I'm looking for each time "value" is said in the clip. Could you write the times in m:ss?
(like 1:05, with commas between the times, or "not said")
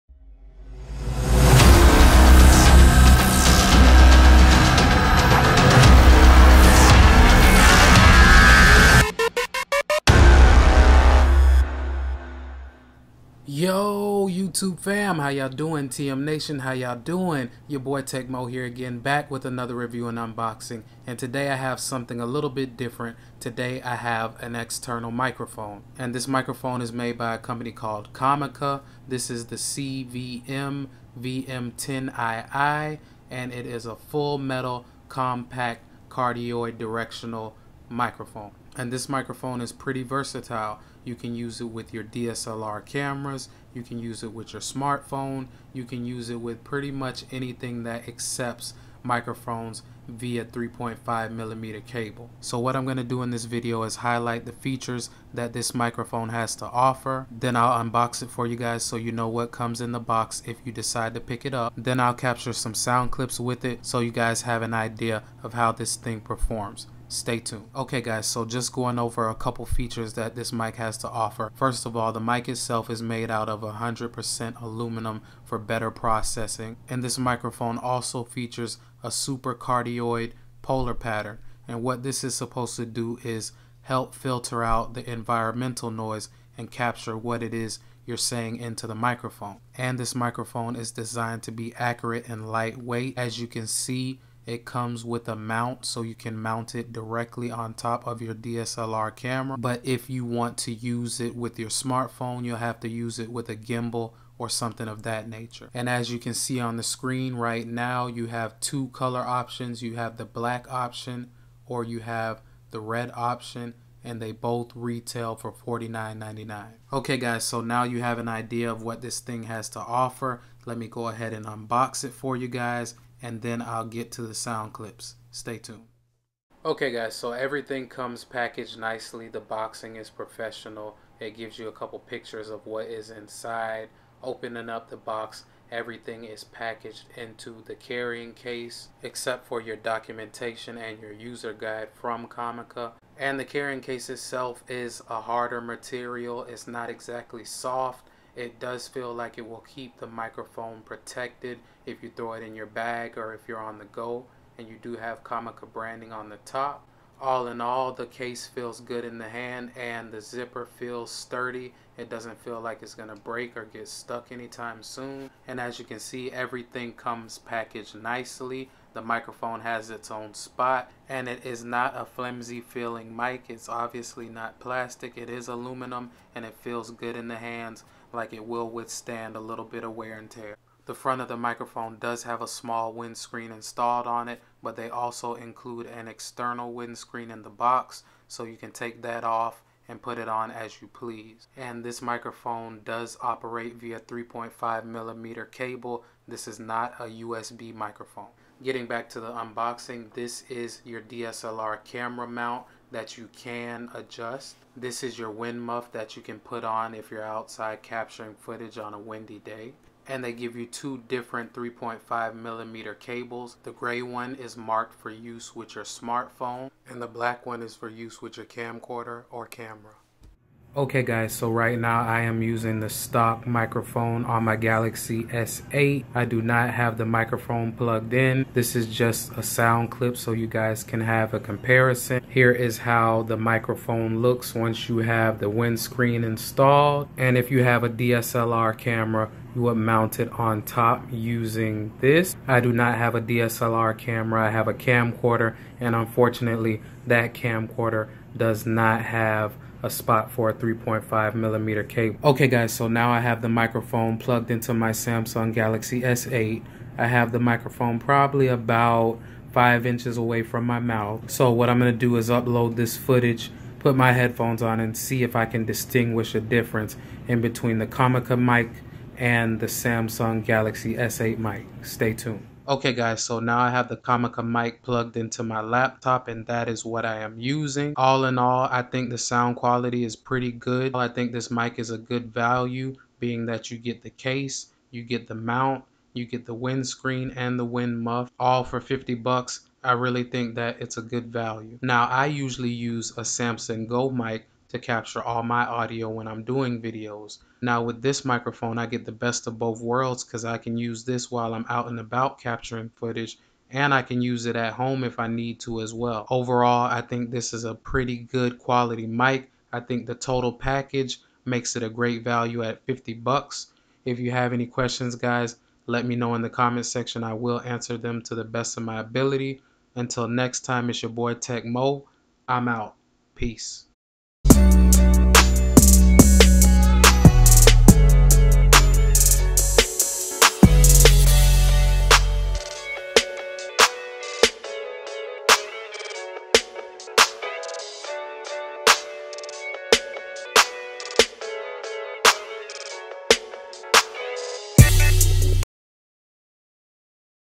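4:42, 4:51, 5:12.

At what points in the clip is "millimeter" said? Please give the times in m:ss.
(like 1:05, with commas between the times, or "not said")
0:51, 3:14, 3:32, 4:11.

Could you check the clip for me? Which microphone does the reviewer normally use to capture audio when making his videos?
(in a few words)
Samson Go mic.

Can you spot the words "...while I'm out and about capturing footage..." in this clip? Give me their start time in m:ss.
5:01.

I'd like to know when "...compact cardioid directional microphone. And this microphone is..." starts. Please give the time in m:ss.
0:35.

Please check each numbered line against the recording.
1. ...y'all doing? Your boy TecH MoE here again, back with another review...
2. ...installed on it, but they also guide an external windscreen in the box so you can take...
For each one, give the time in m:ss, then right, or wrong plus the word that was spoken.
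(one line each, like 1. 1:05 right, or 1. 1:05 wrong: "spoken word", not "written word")
1. 0:16 right
2. 3:03 wrong: "include", not "guide".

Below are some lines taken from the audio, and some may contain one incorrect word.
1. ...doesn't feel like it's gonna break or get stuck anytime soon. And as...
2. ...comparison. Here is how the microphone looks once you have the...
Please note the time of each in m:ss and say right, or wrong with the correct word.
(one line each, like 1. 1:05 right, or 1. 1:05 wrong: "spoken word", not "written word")
1. 2:42 right
2. 3:51 right.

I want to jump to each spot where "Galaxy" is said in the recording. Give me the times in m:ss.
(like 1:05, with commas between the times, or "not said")
3:44, 4:15, 4:30.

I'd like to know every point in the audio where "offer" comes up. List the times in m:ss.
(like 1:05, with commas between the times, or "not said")
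0:56, 1:11, 1:59.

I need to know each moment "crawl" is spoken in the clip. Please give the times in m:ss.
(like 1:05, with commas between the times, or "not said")
not said.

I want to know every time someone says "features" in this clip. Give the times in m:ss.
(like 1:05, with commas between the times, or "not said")
0:54, 1:09, 1:18.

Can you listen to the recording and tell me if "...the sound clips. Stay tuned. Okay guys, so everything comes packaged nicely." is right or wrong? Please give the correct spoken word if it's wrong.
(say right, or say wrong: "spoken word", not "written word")
right.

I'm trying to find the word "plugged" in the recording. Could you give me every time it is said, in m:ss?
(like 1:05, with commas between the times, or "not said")
3:47, 4:14, 4:34.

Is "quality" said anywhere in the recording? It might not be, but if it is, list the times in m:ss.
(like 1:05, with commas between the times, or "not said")
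4:39, 5:08.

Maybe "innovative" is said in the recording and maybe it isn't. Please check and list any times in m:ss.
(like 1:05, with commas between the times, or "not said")
not said.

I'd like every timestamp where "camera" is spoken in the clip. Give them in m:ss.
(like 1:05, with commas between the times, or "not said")
0:42, 1:39, 3:21, 3:39, 3:58, 4:03.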